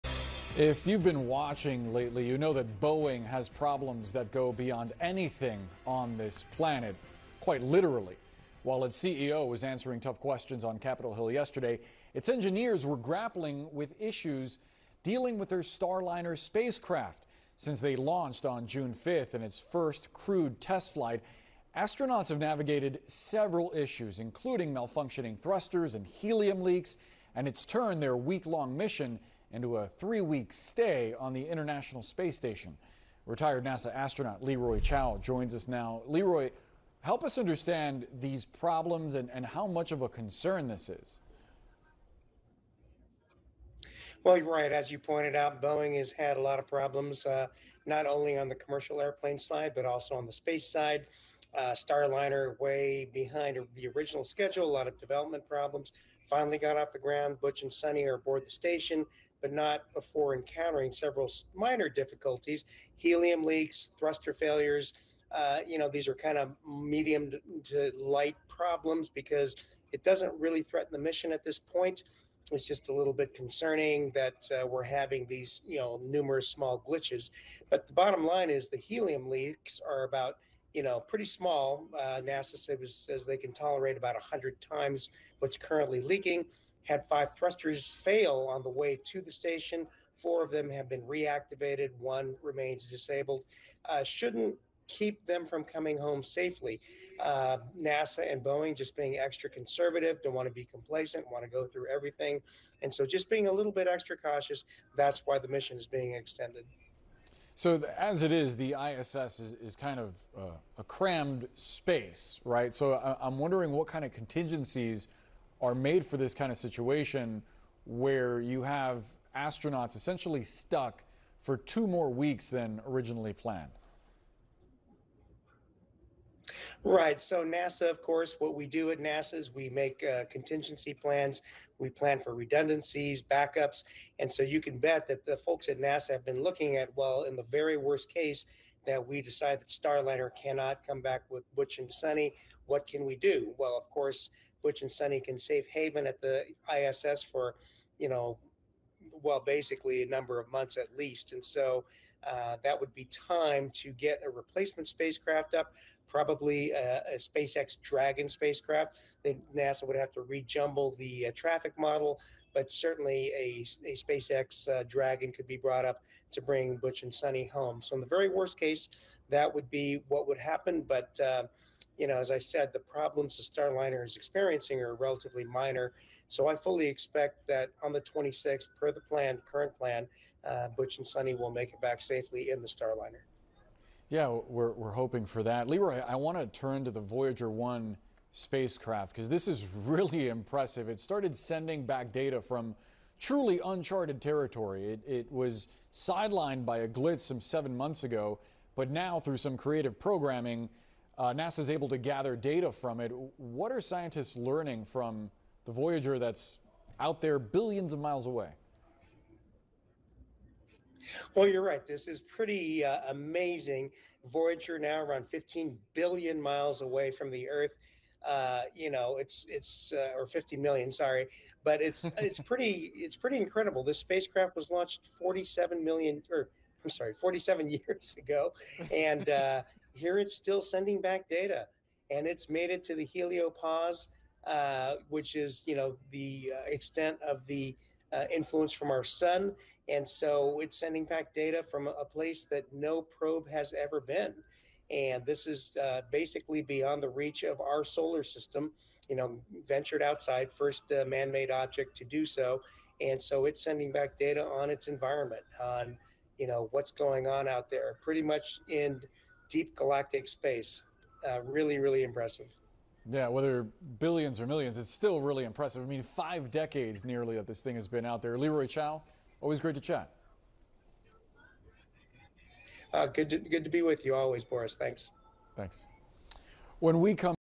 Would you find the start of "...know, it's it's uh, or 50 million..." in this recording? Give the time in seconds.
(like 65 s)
218 s.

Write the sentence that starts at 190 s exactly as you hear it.
It started sending back data from truly uncharted territory.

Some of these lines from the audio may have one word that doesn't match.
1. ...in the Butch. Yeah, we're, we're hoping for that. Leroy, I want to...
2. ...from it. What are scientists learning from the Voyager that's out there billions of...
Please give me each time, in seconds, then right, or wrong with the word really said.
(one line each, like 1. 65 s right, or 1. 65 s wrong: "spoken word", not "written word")
1. 182 s wrong: "Starliner", not "Butch"
2. 202 s right.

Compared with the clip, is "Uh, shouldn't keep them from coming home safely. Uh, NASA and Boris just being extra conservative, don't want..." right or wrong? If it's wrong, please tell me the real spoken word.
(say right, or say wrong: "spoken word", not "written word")
wrong: "Boeing", not "Boris".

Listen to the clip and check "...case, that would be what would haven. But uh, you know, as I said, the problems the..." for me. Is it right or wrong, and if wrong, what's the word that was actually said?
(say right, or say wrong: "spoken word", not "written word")
wrong: "happen", not "haven".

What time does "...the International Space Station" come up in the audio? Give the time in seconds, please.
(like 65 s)
31 s.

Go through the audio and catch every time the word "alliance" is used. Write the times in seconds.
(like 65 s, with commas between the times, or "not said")
not said.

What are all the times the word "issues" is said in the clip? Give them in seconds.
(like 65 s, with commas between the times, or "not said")
13 s, 23 s.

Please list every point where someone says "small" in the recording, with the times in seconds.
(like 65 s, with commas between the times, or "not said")
76 s, 81 s.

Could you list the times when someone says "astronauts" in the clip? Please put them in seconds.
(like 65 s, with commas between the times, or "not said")
21 s, 33 s, 119 s.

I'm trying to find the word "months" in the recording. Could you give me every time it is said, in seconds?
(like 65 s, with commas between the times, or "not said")
150 s, 197 s.